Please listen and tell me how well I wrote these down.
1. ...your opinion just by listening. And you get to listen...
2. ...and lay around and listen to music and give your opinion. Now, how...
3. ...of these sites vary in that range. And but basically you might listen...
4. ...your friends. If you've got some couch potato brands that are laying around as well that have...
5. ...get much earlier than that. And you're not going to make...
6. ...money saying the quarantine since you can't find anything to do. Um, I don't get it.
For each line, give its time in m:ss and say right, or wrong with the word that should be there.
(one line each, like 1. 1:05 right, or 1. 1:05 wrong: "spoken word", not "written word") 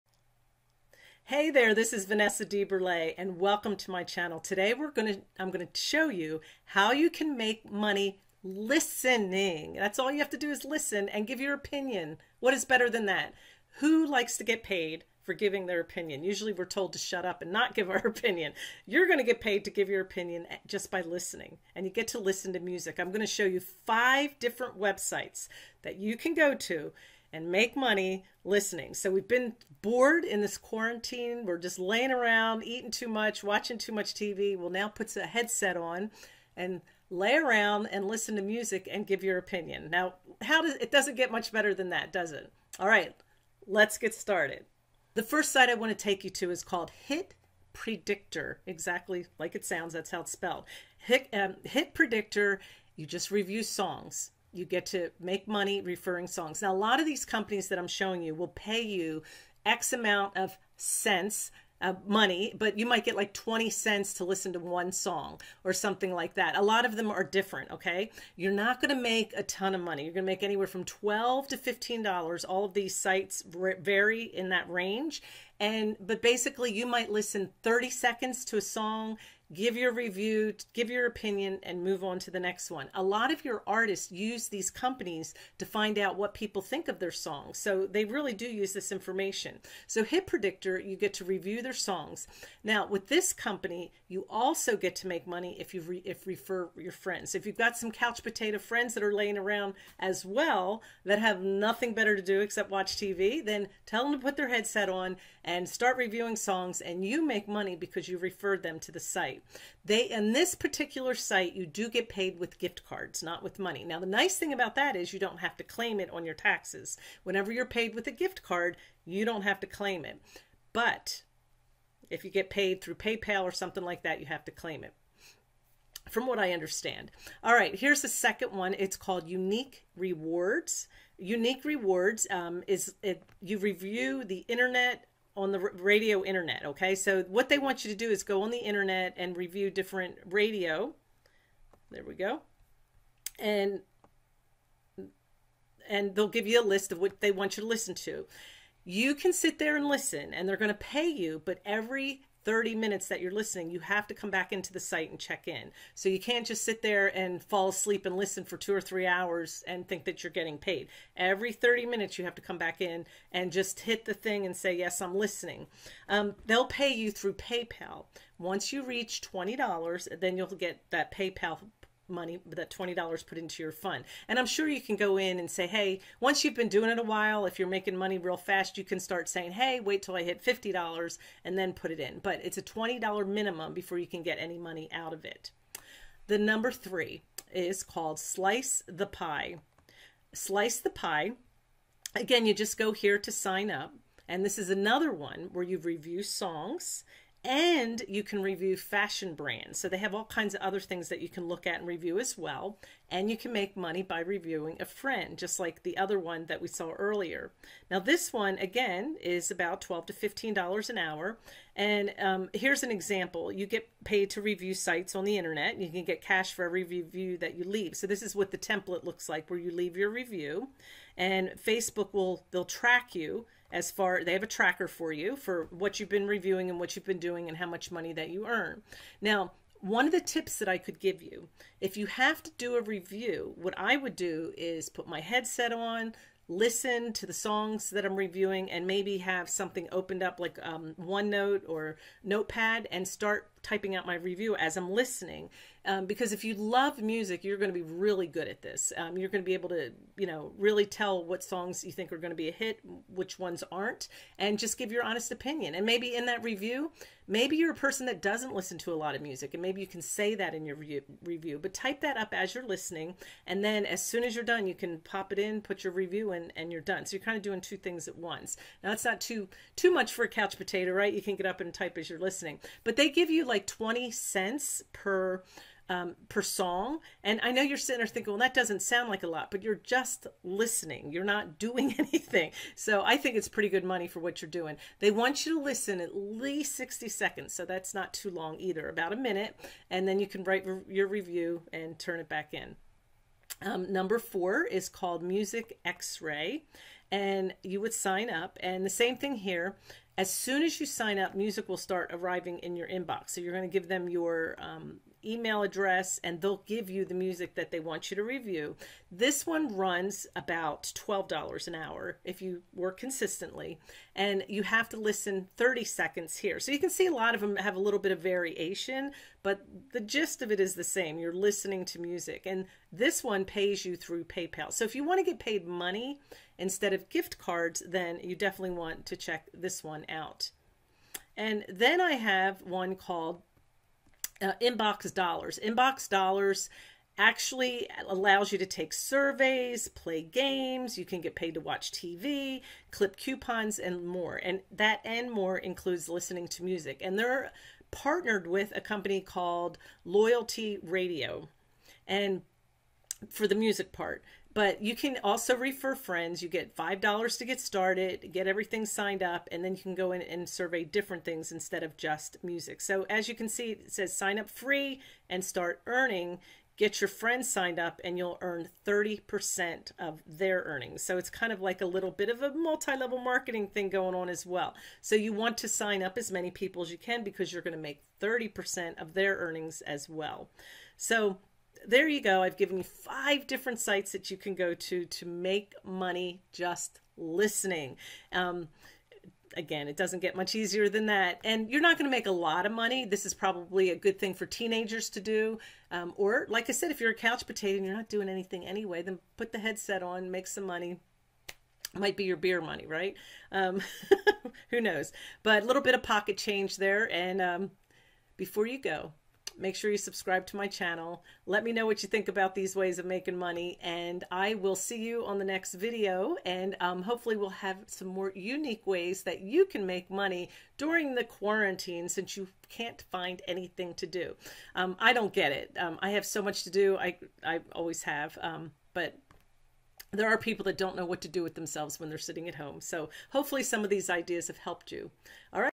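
1. 0:19 right
2. 0:36 right
3. 1:12 right
4. 1:36 wrong: "friends", not "brands"
5. 6:30 wrong: "easier", not "earlier"
6. 7:00 wrong: "during", not "saying".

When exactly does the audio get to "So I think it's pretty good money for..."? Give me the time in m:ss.
4:42.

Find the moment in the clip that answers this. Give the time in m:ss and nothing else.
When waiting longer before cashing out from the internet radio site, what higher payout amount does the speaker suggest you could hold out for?
3:00.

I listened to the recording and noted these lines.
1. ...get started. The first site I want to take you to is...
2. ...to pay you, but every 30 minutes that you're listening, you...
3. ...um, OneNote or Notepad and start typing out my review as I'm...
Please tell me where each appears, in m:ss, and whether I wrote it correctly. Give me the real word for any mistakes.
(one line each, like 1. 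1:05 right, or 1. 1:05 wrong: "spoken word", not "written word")
1. 0:43 right
2. 2:30 right
3. 4:00 right.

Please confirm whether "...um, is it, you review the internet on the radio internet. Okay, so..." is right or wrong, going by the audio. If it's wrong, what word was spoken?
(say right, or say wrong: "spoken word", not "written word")
right.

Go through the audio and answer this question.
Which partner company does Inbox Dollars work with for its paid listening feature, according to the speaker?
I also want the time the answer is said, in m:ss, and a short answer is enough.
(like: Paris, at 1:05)
Loyalty Radio, at 5:50.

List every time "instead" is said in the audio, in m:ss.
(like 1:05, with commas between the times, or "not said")
5:26, 6:01.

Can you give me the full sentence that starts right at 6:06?
Get your friends signed up and you'll earn 30% of their earnings.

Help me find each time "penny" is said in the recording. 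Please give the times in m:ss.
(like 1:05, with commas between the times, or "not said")
not said.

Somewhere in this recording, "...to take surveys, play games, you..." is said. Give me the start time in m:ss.
5:38.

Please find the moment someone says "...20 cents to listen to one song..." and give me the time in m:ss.
1:03.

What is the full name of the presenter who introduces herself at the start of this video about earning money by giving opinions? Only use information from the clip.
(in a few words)
Vanessa DeBurlet.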